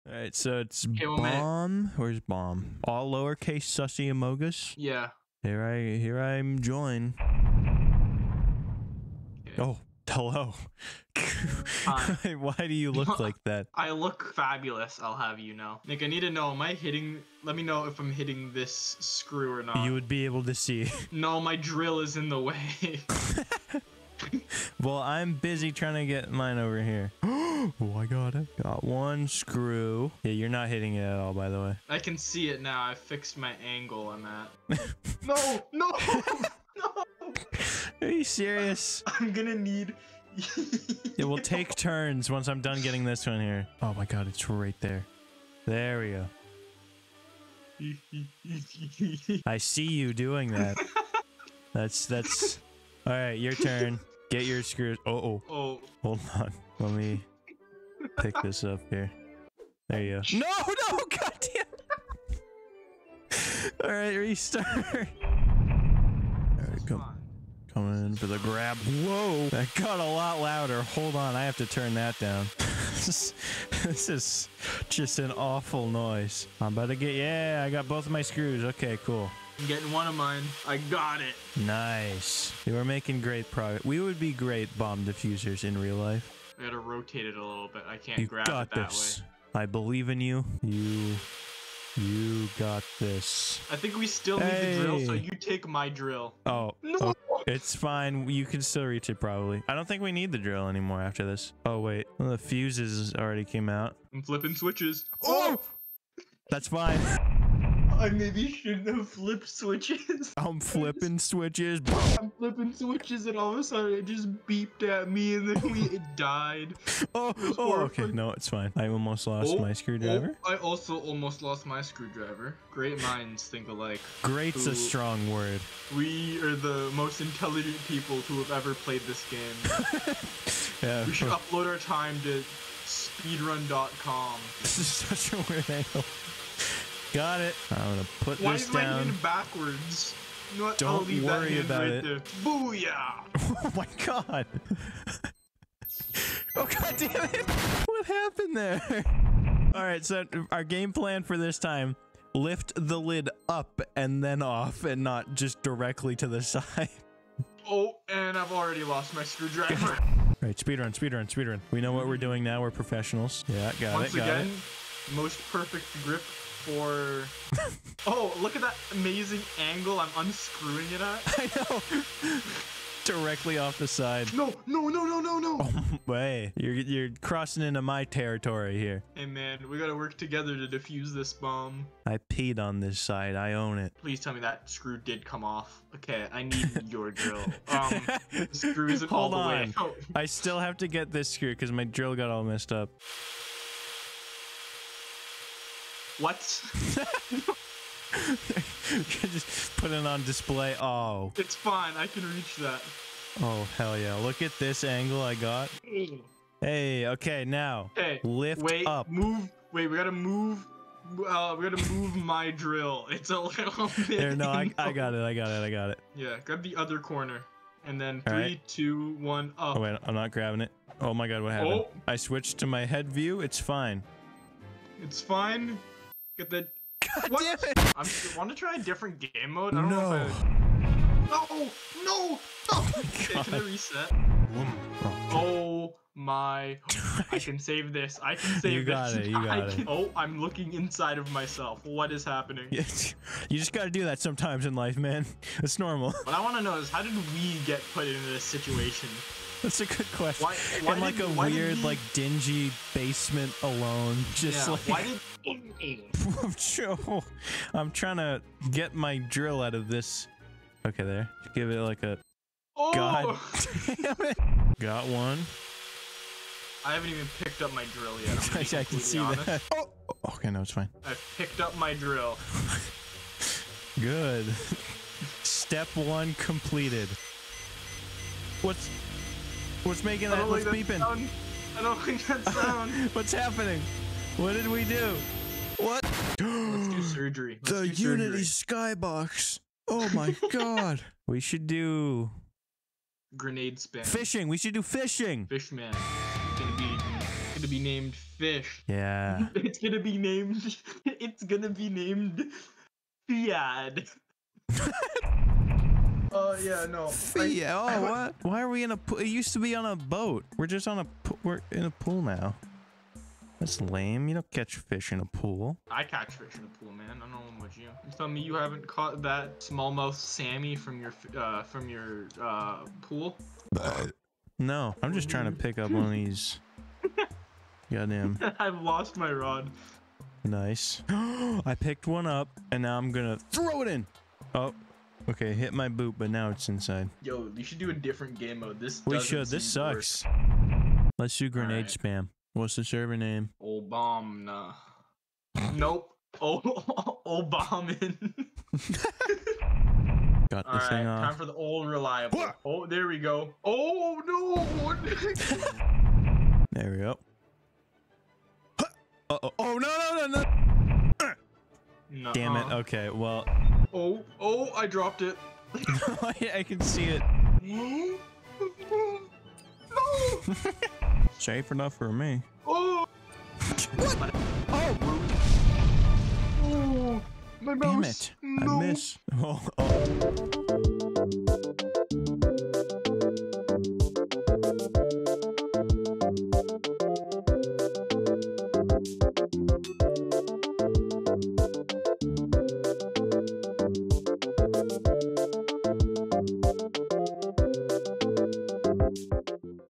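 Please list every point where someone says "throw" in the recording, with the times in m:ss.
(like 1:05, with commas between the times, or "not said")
5:33.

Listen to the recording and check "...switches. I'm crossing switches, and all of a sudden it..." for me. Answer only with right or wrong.
wrong.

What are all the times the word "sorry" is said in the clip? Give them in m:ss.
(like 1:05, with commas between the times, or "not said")
not said.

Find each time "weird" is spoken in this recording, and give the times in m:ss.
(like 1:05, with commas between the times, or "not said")
2:15, 4:11.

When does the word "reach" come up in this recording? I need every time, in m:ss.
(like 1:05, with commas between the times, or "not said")
1:38, 3:22.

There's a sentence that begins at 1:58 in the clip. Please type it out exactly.
I almost lost oh, my screwdriver.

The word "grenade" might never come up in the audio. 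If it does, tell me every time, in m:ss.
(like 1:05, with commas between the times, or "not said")
4:53, 5:41.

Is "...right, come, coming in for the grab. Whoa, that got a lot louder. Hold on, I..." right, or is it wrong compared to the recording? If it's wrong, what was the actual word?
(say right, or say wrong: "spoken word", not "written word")
right.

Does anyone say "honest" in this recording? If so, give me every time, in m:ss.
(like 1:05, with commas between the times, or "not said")
4:29.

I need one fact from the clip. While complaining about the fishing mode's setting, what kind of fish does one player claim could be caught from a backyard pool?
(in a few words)
smallmouth Sammy.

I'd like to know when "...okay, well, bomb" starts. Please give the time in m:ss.
0:00.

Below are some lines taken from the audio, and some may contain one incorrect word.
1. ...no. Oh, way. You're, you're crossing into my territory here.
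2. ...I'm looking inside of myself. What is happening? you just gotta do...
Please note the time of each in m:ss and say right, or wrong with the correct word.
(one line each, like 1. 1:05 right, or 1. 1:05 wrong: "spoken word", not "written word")
1. 2:55 right
2. 4:00 right.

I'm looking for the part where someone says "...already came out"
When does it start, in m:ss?
1:43.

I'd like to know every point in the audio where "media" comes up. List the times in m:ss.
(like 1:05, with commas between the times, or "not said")
not said.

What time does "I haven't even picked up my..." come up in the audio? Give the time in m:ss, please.
4:26.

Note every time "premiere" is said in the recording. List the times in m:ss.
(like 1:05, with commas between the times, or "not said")
not said.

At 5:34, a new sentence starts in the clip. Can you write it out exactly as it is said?
Oh, Okay, hit my boot, but now it's inside.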